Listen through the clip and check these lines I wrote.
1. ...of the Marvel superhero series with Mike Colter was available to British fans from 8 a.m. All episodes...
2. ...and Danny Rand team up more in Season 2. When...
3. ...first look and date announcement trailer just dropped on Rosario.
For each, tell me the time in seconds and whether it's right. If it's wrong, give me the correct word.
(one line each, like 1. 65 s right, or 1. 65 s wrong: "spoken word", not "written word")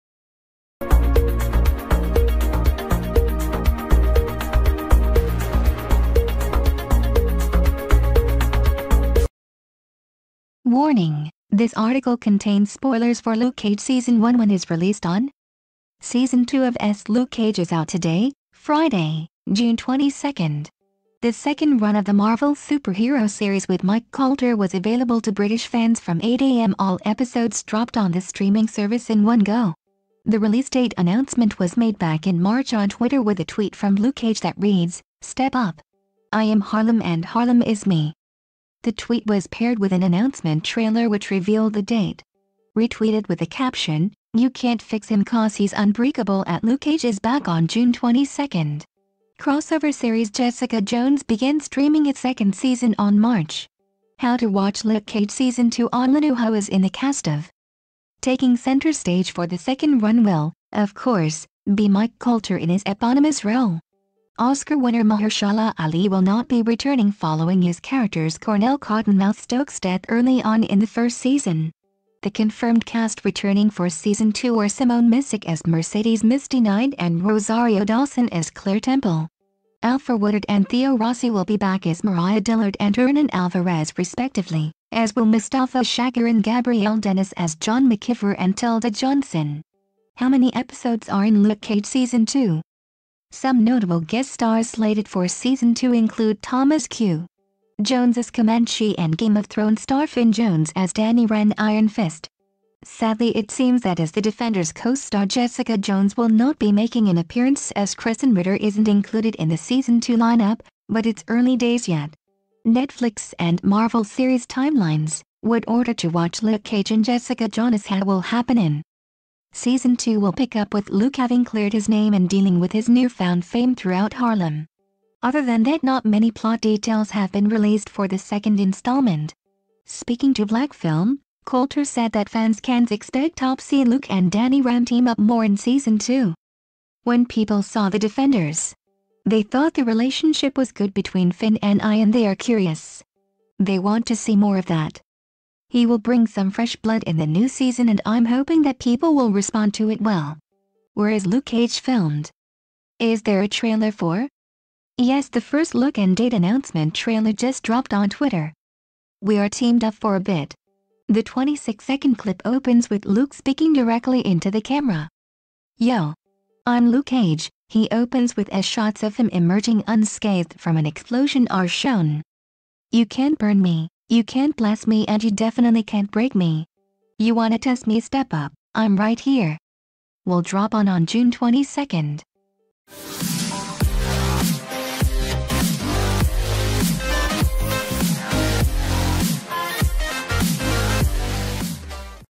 1. 21 s right
2. 134 s right
3. 155 s wrong: "Twitter", not "Rosario".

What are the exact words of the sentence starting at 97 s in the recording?
Jones as Comanche and Game of Thrones star Finn Jones as Danny Rand Iron Fist.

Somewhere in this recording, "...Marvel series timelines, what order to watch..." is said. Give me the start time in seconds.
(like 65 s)
113 s.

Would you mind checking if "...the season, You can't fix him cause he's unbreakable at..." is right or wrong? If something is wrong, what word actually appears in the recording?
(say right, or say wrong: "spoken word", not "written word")
wrong: "caption", not "season".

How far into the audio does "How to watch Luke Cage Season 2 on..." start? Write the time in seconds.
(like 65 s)
54 s.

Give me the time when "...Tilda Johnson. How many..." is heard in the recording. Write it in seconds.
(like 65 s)
88 s.